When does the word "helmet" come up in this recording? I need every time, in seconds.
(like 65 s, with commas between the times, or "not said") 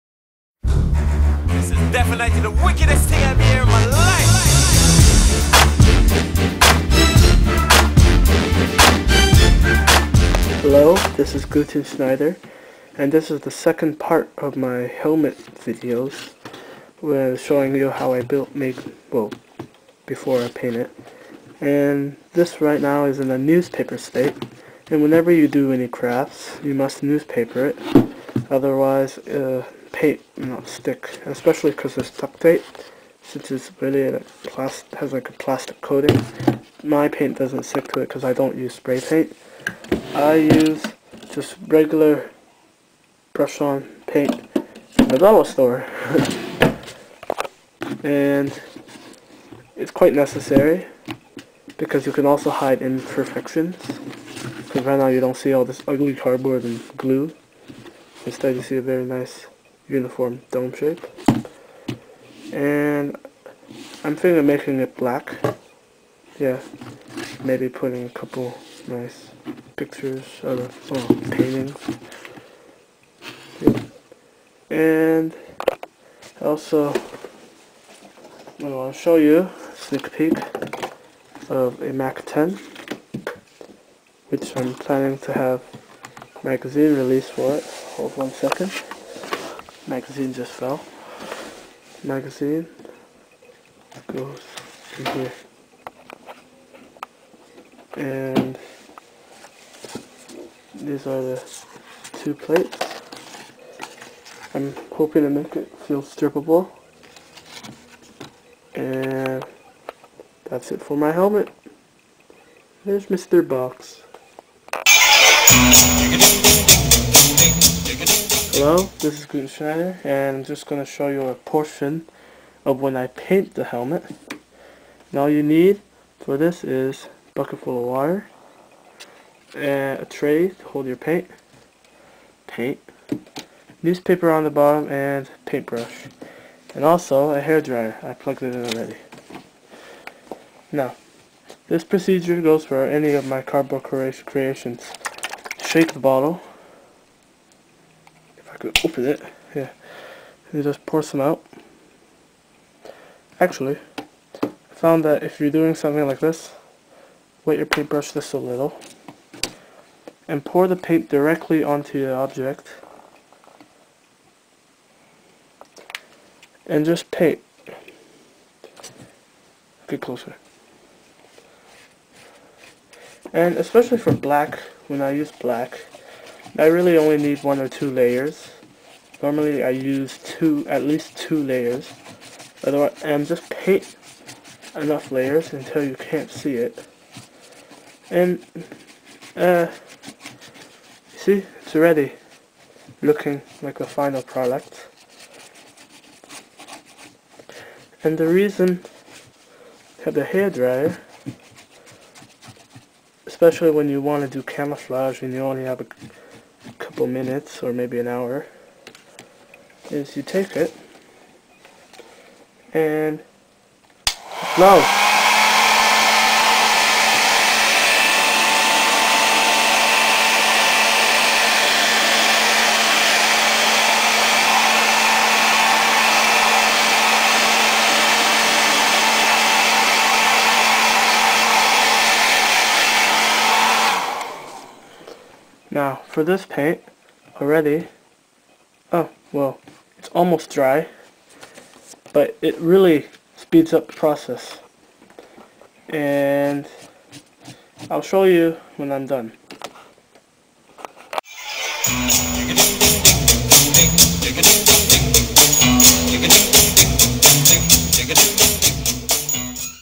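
14 s, 111 s, 123 s.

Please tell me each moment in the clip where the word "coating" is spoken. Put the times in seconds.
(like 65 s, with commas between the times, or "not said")
35 s.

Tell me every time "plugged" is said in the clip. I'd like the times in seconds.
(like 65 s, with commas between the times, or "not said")
138 s.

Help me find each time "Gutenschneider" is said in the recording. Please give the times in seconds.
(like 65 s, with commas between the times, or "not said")
11 s, 119 s.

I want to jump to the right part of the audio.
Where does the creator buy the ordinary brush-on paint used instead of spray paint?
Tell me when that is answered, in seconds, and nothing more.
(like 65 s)
45 s.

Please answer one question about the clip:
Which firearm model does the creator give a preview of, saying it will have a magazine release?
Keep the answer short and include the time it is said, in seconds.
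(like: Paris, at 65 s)
Mac 10, at 81 s.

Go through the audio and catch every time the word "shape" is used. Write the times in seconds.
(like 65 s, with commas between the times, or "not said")
60 s.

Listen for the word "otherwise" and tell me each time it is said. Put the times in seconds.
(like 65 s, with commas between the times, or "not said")
28 s, 182 s.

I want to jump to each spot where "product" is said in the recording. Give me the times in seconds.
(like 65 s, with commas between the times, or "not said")
194 s.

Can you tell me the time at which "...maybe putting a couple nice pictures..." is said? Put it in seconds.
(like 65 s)
67 s.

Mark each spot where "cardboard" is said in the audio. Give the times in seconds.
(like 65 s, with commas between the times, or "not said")
56 s, 143 s.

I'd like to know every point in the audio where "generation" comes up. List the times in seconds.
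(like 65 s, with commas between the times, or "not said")
not said.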